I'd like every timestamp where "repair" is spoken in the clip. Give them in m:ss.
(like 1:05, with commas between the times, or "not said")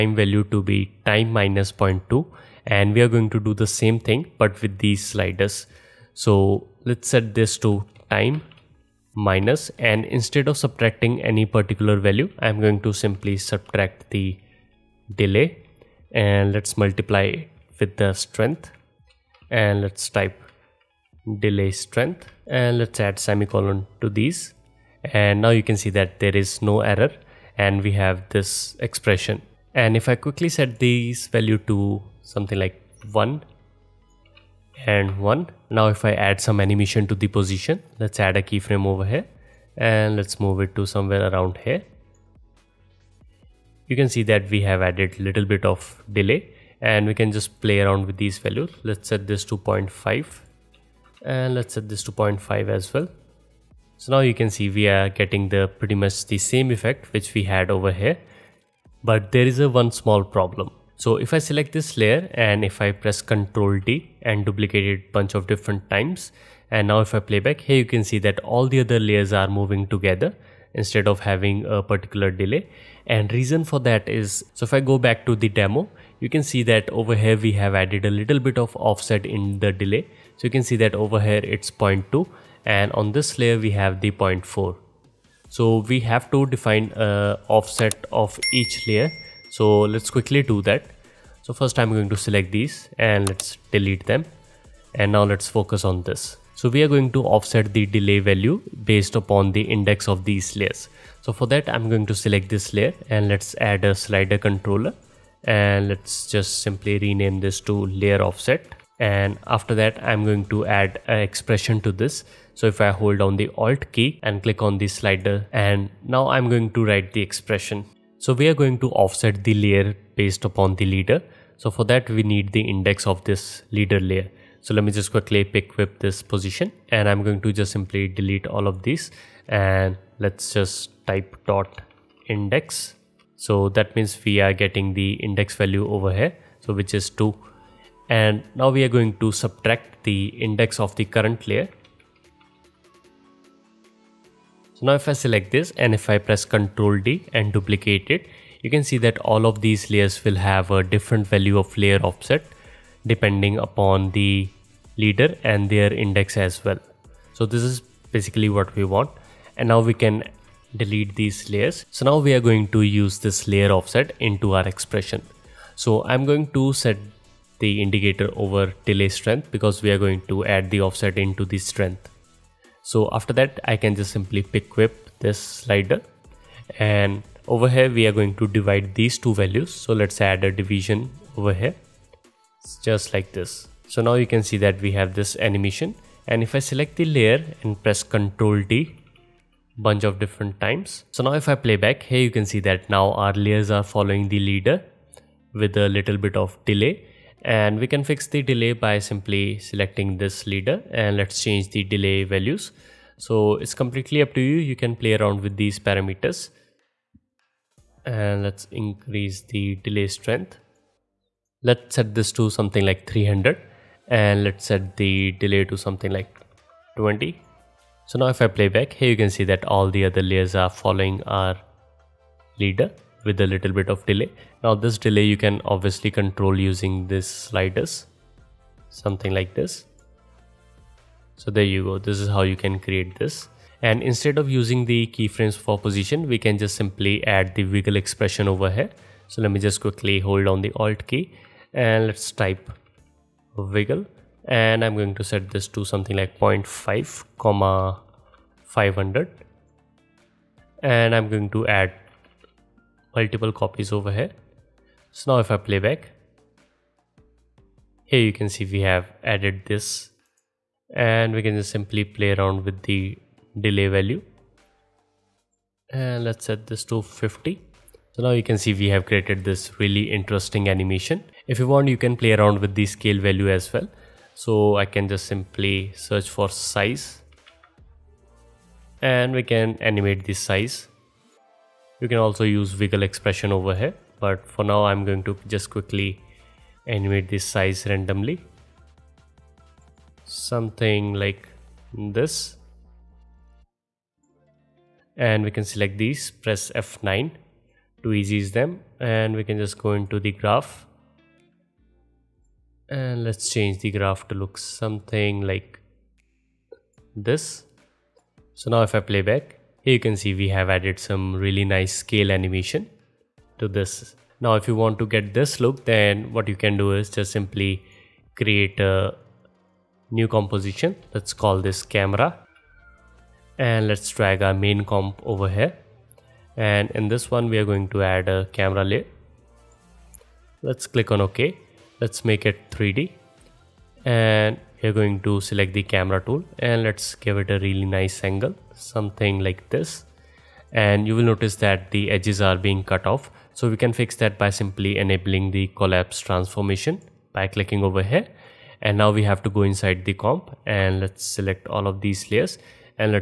not said.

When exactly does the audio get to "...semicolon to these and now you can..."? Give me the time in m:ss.
0:23.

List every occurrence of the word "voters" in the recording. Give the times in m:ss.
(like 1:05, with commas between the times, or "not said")
not said.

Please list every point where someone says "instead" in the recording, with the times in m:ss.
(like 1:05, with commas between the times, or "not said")
0:10, 1:10, 3:54.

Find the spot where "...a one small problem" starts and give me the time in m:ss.
0:59.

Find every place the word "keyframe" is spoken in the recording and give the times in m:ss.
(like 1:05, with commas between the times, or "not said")
0:38, 3:55.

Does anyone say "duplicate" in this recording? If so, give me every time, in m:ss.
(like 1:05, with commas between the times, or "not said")
1:04, 2:27.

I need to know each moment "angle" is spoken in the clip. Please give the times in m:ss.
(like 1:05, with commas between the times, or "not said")
5:38.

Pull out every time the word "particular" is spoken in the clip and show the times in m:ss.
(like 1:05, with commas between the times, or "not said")
0:11, 1:11.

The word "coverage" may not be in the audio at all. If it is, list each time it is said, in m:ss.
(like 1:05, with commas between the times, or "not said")
not said.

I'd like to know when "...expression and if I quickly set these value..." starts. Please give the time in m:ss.
0:28.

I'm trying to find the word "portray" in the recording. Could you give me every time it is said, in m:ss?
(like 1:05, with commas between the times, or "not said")
not said.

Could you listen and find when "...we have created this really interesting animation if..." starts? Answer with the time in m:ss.
4:28.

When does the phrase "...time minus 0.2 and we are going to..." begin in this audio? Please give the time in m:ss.
0:01.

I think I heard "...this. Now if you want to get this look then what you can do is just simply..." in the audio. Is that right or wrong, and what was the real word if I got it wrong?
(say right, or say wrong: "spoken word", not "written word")
right.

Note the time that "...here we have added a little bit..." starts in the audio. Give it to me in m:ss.
1:17.